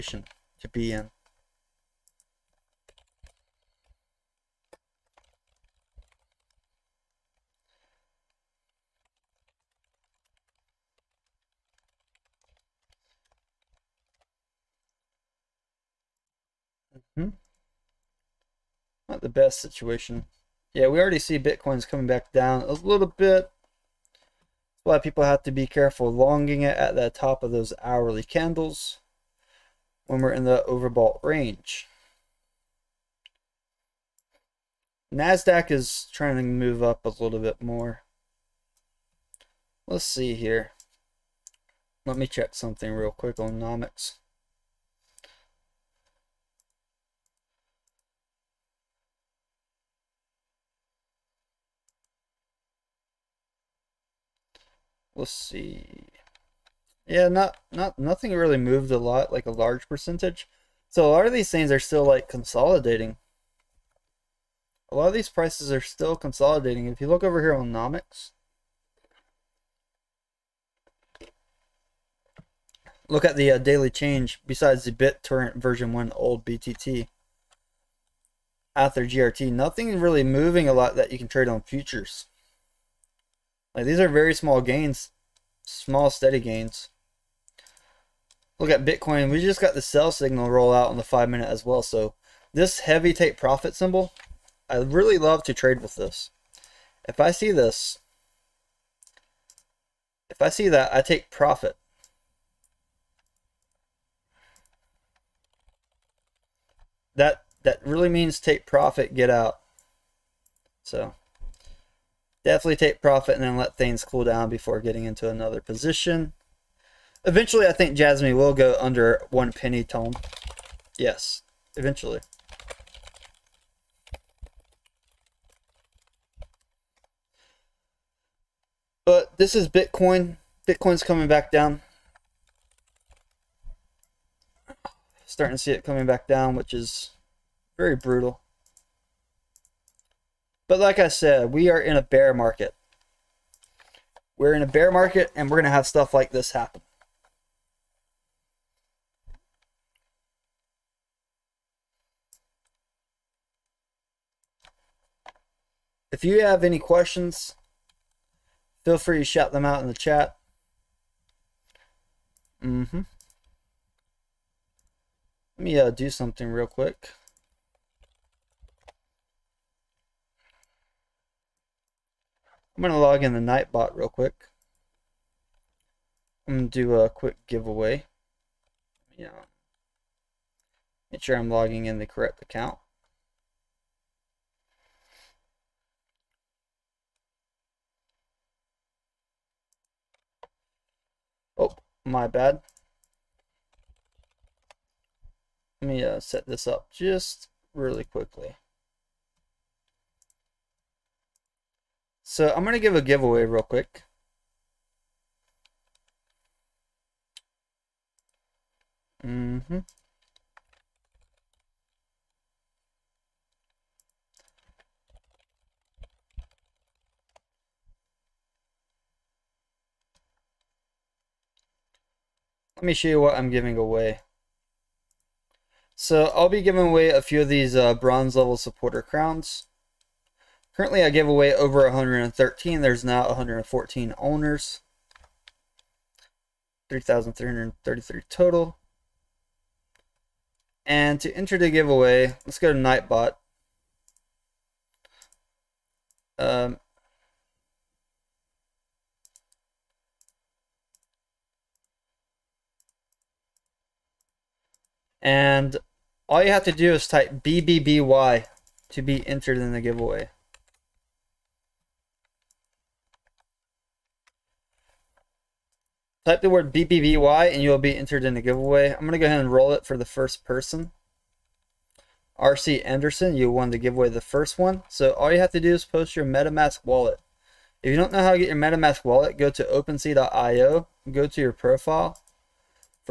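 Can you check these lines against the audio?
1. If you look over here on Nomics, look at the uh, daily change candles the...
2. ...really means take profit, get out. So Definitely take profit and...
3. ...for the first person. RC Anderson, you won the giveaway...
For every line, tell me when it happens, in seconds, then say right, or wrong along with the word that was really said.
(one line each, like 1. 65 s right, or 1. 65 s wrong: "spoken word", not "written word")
1. 66 s wrong: "besides", not "candles"
2. 107 s right
3. 269 s right.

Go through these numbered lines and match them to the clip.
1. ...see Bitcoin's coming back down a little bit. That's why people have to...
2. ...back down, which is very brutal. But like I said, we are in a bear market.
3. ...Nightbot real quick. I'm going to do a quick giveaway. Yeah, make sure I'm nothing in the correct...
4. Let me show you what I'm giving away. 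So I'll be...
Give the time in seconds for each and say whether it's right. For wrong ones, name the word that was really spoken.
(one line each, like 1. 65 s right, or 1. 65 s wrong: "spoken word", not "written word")
1. 21 s right
2. 136 s right
3. 173 s wrong: "logging", not "nothing"
4. 222 s right.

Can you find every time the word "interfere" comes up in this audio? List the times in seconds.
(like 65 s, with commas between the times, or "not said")
not said.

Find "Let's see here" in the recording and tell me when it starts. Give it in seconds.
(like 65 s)
39 s.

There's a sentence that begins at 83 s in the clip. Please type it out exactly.
Like these are very small gains, small steady gains.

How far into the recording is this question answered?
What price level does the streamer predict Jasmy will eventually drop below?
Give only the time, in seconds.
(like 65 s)
119 s.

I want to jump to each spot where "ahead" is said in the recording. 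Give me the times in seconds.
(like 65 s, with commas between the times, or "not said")
269 s.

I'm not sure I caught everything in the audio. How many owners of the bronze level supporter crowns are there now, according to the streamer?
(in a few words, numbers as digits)
114.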